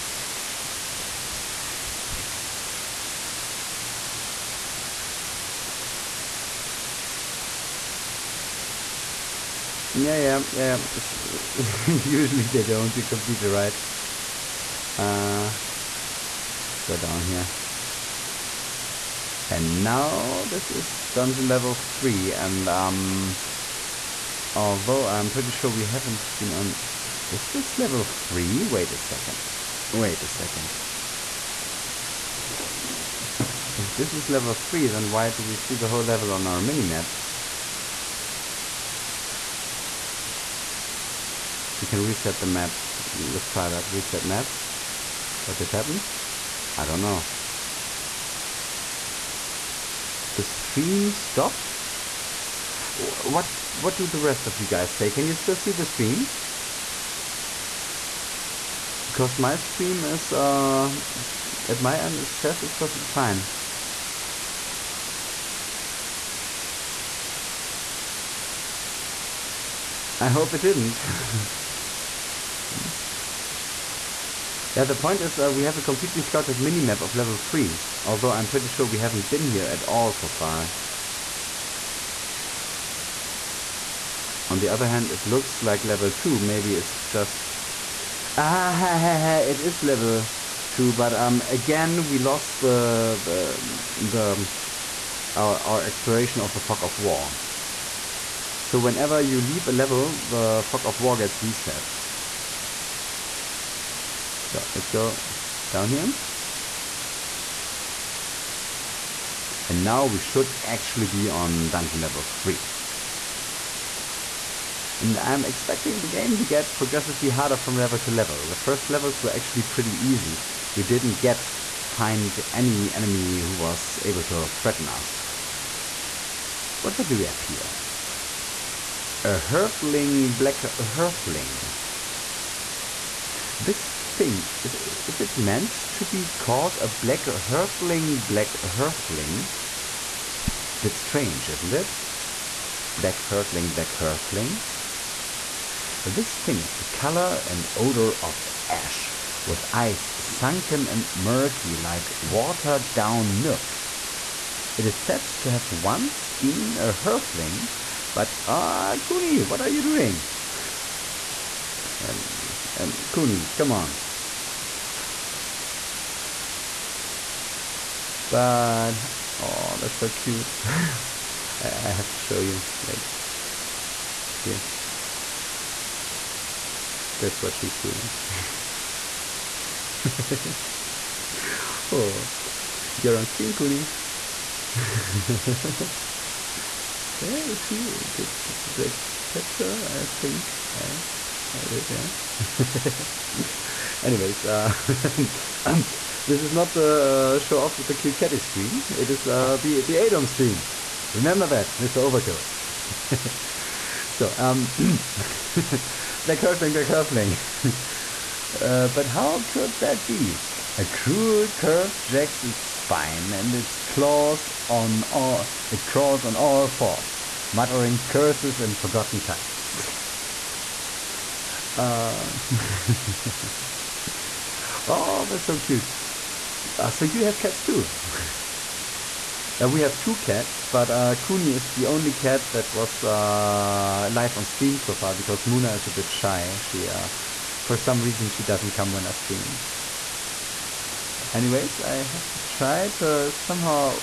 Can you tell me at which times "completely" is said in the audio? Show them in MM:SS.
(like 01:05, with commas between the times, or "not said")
00:13, 01:15.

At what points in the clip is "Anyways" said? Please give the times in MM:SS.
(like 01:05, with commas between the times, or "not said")
03:14, 04:01.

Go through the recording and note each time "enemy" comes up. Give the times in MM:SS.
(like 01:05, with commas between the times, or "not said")
02:02.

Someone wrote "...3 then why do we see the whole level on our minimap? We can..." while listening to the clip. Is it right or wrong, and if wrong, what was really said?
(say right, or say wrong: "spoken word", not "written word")
right.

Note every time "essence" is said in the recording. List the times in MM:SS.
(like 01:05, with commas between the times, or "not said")
not said.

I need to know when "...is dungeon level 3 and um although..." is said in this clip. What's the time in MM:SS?
00:20.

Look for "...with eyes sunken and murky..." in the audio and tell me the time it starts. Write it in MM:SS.
02:29.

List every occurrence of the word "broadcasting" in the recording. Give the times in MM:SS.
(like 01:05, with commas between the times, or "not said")
not said.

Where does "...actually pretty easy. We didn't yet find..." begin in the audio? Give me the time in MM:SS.
01:59.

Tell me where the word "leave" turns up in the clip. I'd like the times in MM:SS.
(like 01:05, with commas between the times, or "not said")
01:39.